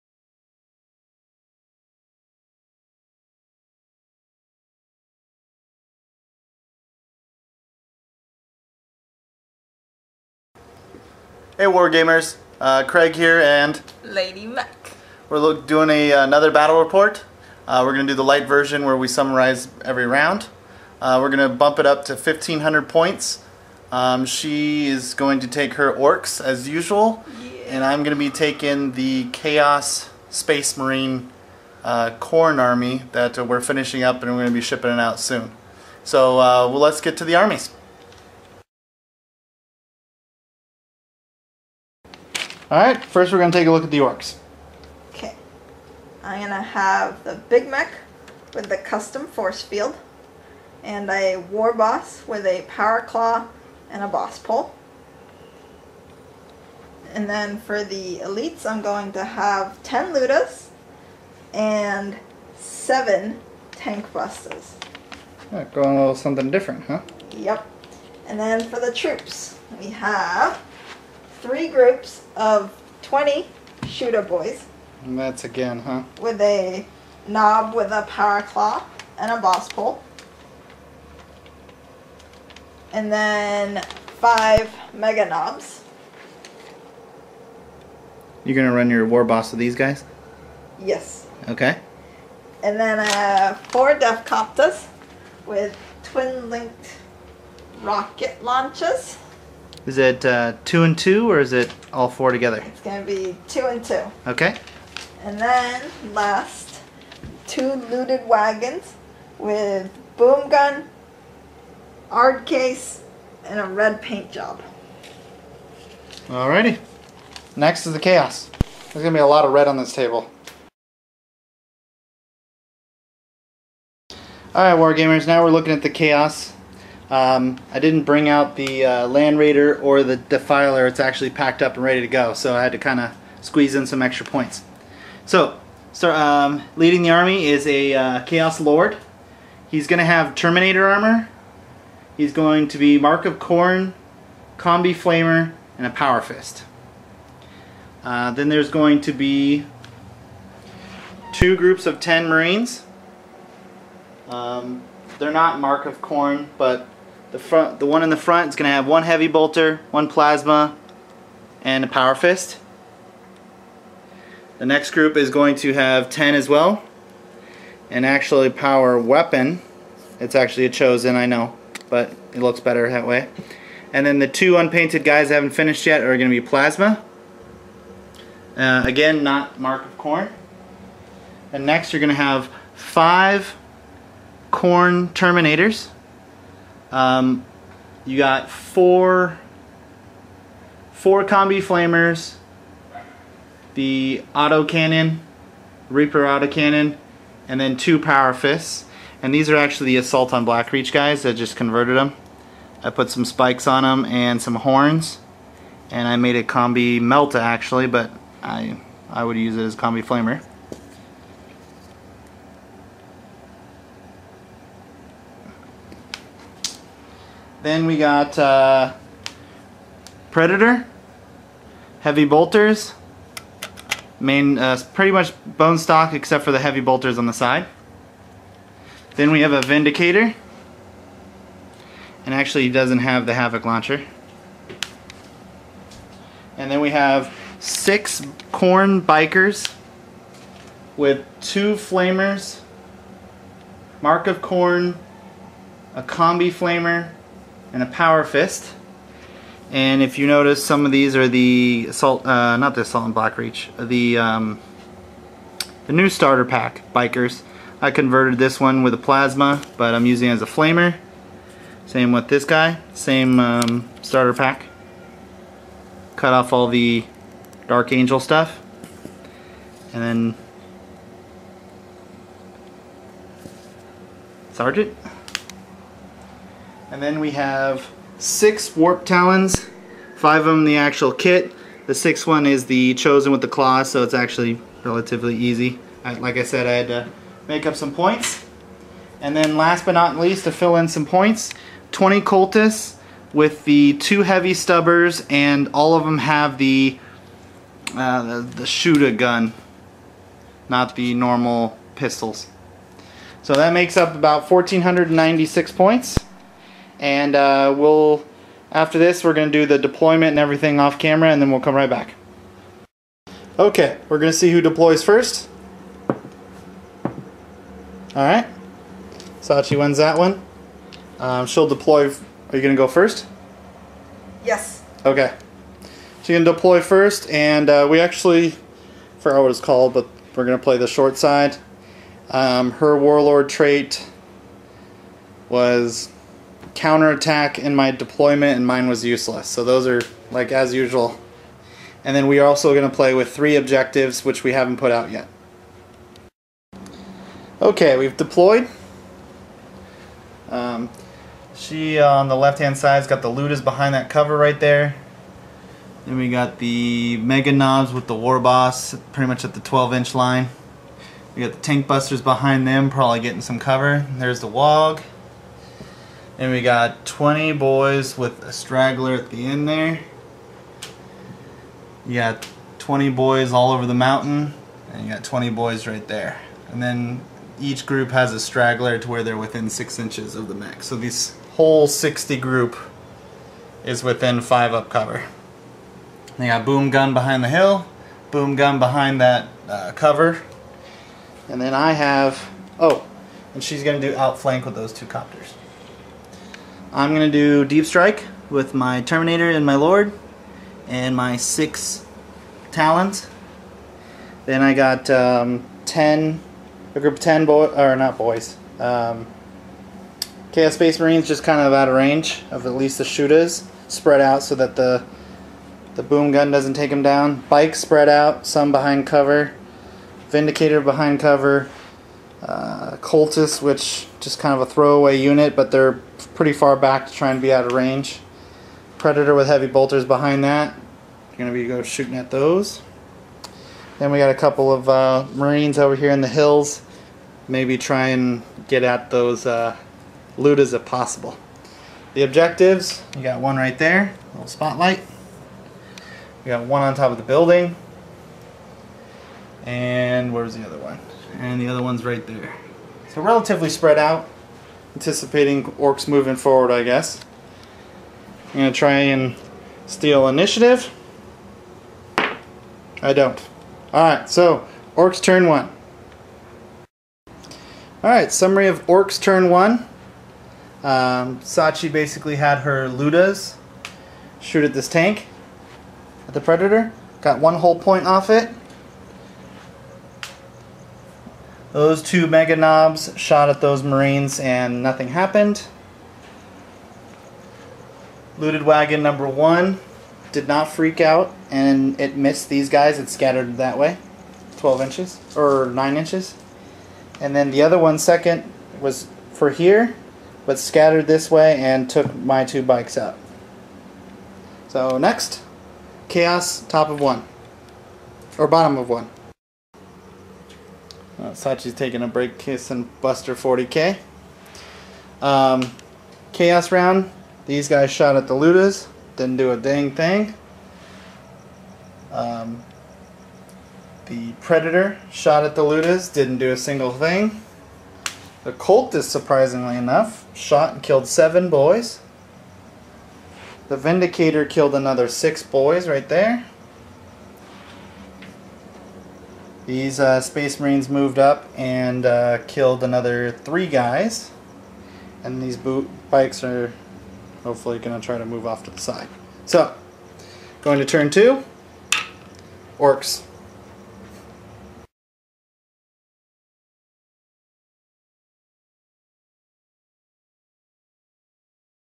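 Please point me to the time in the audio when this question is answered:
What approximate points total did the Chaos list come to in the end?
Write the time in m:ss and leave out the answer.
5:04.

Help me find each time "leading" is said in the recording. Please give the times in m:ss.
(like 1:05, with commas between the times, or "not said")
2:16.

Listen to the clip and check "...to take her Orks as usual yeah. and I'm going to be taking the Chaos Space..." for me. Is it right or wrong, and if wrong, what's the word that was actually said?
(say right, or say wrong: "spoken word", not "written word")
right.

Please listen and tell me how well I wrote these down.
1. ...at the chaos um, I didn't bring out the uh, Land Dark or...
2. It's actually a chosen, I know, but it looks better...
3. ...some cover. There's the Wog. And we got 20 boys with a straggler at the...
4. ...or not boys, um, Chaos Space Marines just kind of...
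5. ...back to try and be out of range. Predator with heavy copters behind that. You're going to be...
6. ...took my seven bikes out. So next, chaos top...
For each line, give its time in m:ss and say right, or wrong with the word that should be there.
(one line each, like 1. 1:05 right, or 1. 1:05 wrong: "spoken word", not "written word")
1. 2:05 wrong: "Raider", not "Dark"
2. 2:50 right
3. 6:03 right
4. 6:47 right
5. 7:06 wrong: "bolters", not "copters"
6. 8:21 wrong: "two", not "seven".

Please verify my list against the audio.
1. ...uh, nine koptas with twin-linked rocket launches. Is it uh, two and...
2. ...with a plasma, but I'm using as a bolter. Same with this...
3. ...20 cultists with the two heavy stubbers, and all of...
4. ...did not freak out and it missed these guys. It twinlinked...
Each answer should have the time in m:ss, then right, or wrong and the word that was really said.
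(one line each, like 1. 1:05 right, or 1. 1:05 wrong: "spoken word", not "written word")
1. 1:32 wrong: "four", not "nine"
2. 4:18 wrong: "flamer", not "bolter"
3. 4:51 right
4. 8:10 wrong: "scattered", not "twinlinked".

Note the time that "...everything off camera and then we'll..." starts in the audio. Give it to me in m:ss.
5:10.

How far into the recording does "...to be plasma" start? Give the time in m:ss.
2:56.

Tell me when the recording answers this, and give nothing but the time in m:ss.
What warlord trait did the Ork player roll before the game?
5:36.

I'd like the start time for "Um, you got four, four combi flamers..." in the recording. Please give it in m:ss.
3:06.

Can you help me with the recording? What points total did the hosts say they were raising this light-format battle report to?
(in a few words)
1500.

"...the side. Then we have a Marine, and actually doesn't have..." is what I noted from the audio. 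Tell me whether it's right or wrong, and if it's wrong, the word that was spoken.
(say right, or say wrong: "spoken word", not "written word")
wrong: "Vindicator", not "Marine".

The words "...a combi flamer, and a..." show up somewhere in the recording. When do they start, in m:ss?
4:05.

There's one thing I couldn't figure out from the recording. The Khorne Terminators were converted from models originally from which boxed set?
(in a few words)
Assault on Blackreach.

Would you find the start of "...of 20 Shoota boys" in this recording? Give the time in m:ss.
1:12.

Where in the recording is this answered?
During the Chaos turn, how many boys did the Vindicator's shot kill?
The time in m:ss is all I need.
8:55.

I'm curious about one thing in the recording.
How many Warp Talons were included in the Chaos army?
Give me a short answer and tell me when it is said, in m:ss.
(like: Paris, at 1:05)
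6, at 4:38.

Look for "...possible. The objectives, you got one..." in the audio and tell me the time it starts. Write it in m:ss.
7:20.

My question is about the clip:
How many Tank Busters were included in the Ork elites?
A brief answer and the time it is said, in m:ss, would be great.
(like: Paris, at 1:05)
7, at 1:02.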